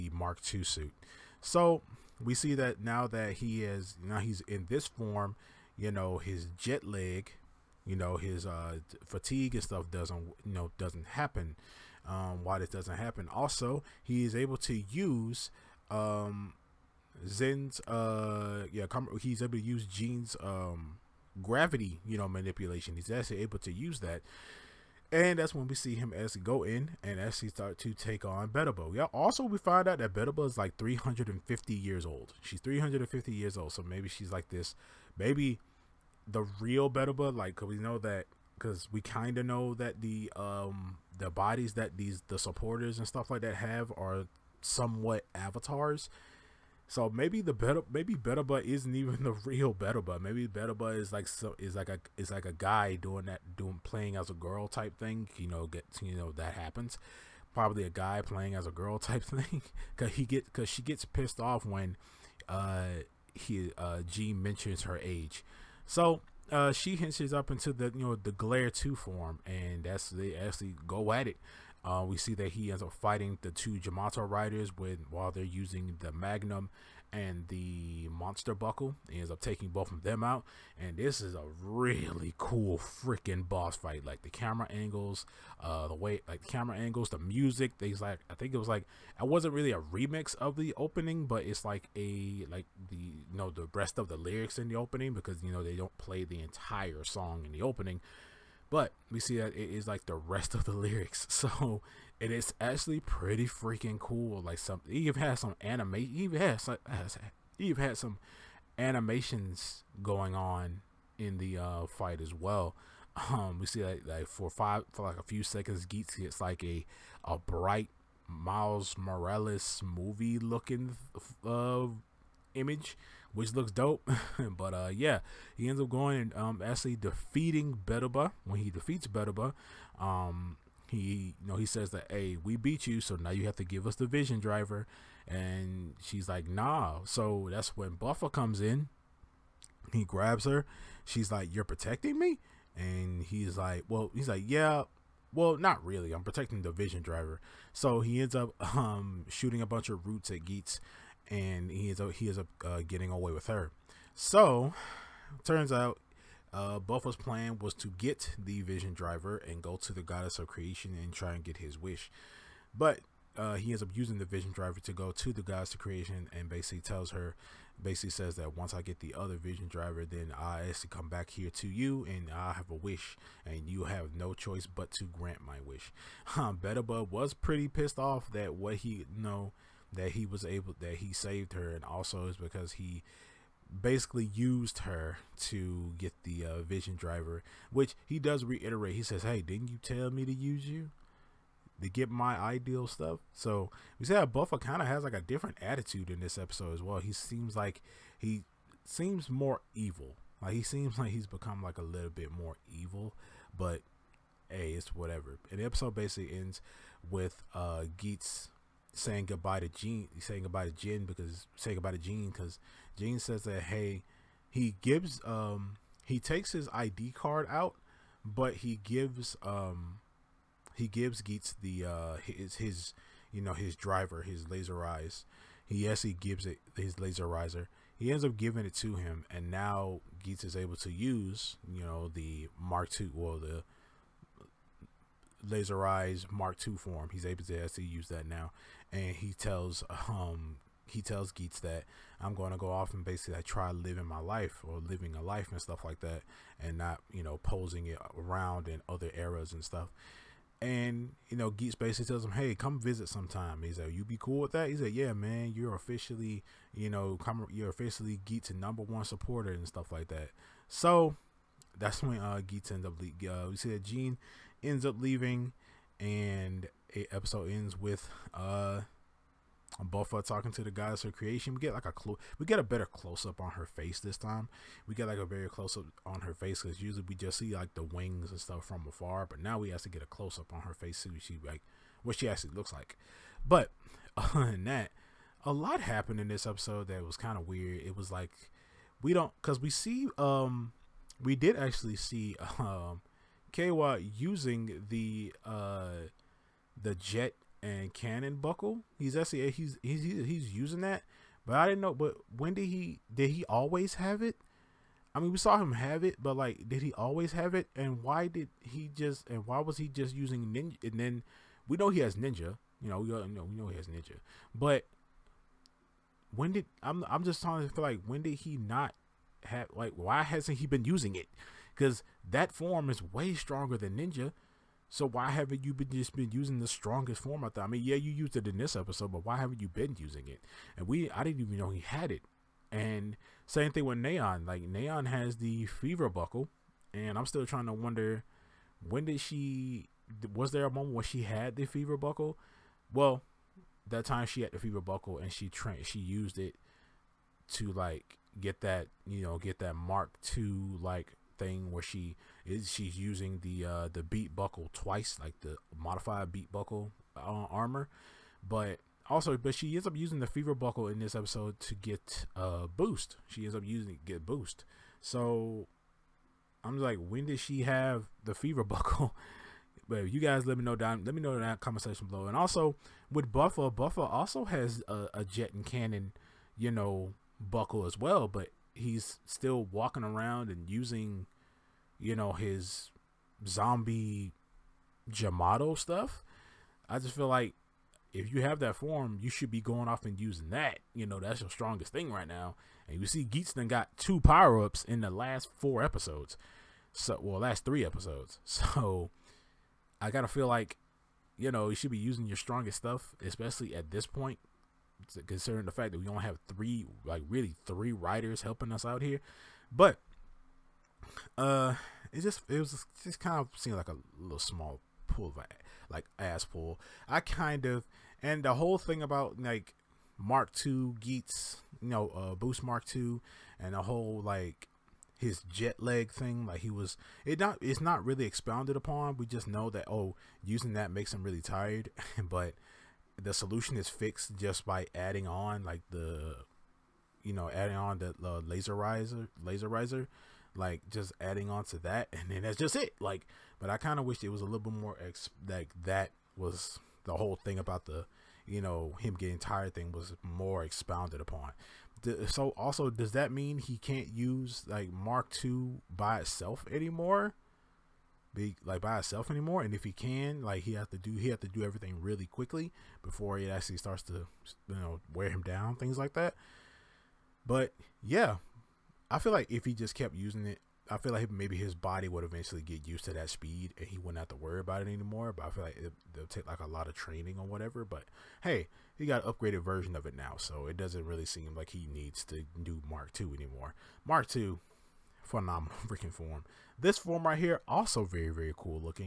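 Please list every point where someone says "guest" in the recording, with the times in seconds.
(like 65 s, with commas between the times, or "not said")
not said.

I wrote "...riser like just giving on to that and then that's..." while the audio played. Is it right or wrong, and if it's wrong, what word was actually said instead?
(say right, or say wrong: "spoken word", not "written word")
wrong: "adding", not "giving".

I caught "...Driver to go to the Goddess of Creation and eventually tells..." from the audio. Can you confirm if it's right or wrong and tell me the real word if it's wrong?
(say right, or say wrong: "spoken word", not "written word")
wrong: "basically", not "eventually".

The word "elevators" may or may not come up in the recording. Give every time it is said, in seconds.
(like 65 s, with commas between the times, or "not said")
not said.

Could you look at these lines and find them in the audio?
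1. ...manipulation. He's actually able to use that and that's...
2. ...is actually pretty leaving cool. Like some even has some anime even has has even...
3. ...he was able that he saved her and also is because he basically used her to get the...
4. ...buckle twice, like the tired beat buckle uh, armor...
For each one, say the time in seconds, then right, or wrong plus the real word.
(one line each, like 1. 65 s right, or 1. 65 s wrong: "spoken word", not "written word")
1. 22 s right
2. 102 s wrong: "freaking", not "leaving"
3. 180 s right
4. 354 s wrong: "modified", not "tired".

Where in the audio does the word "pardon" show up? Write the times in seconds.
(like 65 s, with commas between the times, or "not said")
not said.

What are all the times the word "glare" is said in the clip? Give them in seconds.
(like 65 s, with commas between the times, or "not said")
68 s.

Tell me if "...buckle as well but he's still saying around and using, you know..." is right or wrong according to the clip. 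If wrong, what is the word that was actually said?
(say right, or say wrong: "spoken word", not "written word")
wrong: "walking", not "saying".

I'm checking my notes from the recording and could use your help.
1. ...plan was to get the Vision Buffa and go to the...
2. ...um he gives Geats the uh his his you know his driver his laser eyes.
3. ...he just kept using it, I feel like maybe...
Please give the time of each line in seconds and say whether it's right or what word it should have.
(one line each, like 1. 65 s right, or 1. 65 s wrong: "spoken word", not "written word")
1. 157 s wrong: "Driver", not "Buffa"
2. 219 s right
3. 469 s right.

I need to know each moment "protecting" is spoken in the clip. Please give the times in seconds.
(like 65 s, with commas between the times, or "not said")
141 s, 146 s.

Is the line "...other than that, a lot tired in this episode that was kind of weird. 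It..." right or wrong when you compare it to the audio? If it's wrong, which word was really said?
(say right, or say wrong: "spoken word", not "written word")
wrong: "happened", not "tired".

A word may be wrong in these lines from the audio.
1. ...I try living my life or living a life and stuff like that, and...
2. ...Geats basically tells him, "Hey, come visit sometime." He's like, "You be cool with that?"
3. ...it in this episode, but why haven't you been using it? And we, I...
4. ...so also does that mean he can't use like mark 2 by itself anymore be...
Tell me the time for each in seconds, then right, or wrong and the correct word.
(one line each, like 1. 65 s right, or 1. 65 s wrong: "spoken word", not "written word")
1. 243 s right
2. 251 s right
3. 328 s right
4. 452 s right.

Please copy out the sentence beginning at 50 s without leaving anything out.
Maybe But is like so is like a is like a guy doing that doing playing as a girl type thing.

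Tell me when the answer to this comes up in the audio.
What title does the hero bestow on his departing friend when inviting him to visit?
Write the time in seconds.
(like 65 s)
258 s.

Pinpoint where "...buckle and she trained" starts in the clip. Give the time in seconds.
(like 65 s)
344 s.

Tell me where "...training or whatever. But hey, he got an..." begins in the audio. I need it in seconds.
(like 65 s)
476 s.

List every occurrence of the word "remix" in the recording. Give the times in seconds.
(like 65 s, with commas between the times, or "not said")
89 s.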